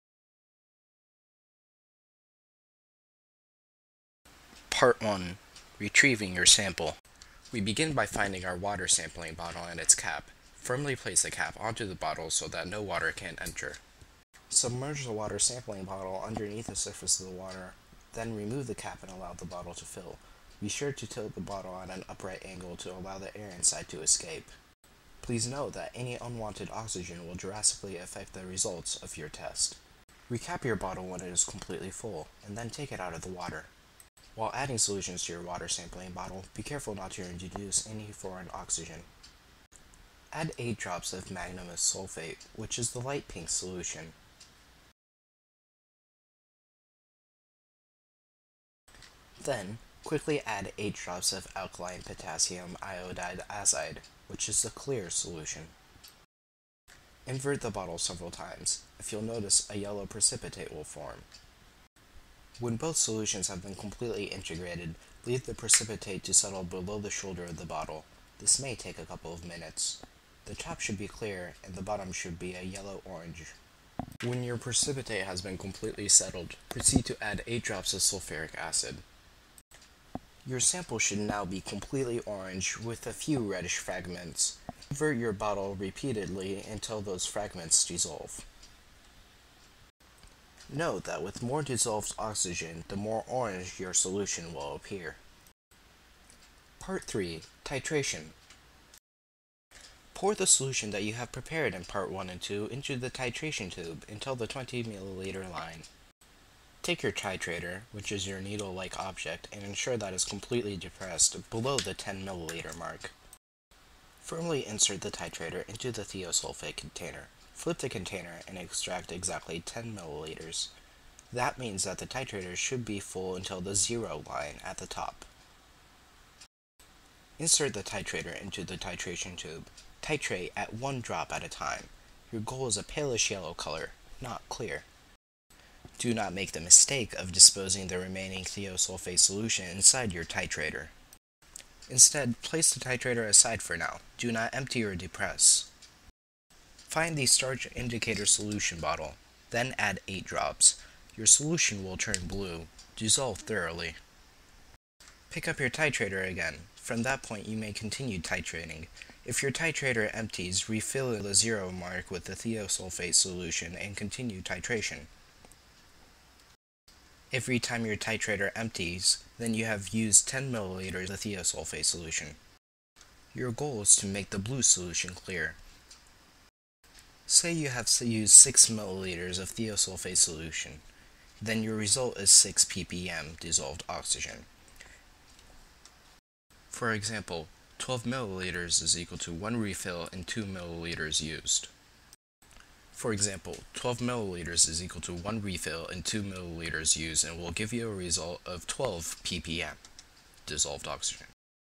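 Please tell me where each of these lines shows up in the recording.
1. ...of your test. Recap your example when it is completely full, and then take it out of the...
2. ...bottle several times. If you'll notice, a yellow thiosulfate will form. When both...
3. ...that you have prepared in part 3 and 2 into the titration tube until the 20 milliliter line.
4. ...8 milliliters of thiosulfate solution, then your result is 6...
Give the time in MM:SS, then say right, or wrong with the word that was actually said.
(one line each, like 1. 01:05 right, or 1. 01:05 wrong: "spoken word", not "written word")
1. 00:29 wrong: "bottle", not "example"
2. 00:57 wrong: "precipitate", not "thiosulfate"
3. 01:40 wrong: "1", not "3"
4. 02:58 wrong: "6", not "8".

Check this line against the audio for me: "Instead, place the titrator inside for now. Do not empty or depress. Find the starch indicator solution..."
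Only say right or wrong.
wrong.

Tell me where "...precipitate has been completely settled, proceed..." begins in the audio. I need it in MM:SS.
01:14.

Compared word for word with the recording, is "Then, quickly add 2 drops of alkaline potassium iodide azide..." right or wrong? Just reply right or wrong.
wrong.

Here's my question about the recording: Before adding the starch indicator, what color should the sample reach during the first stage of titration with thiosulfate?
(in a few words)
palish yellow.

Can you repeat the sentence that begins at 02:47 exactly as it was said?
Every time your titrator empties, then you have used 10 milliliters of the thiosulfate solution.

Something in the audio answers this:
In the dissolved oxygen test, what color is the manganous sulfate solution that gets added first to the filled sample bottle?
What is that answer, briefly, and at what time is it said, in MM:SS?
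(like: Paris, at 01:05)
light pink, at 00:43.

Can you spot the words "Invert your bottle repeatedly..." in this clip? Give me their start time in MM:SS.
01:24.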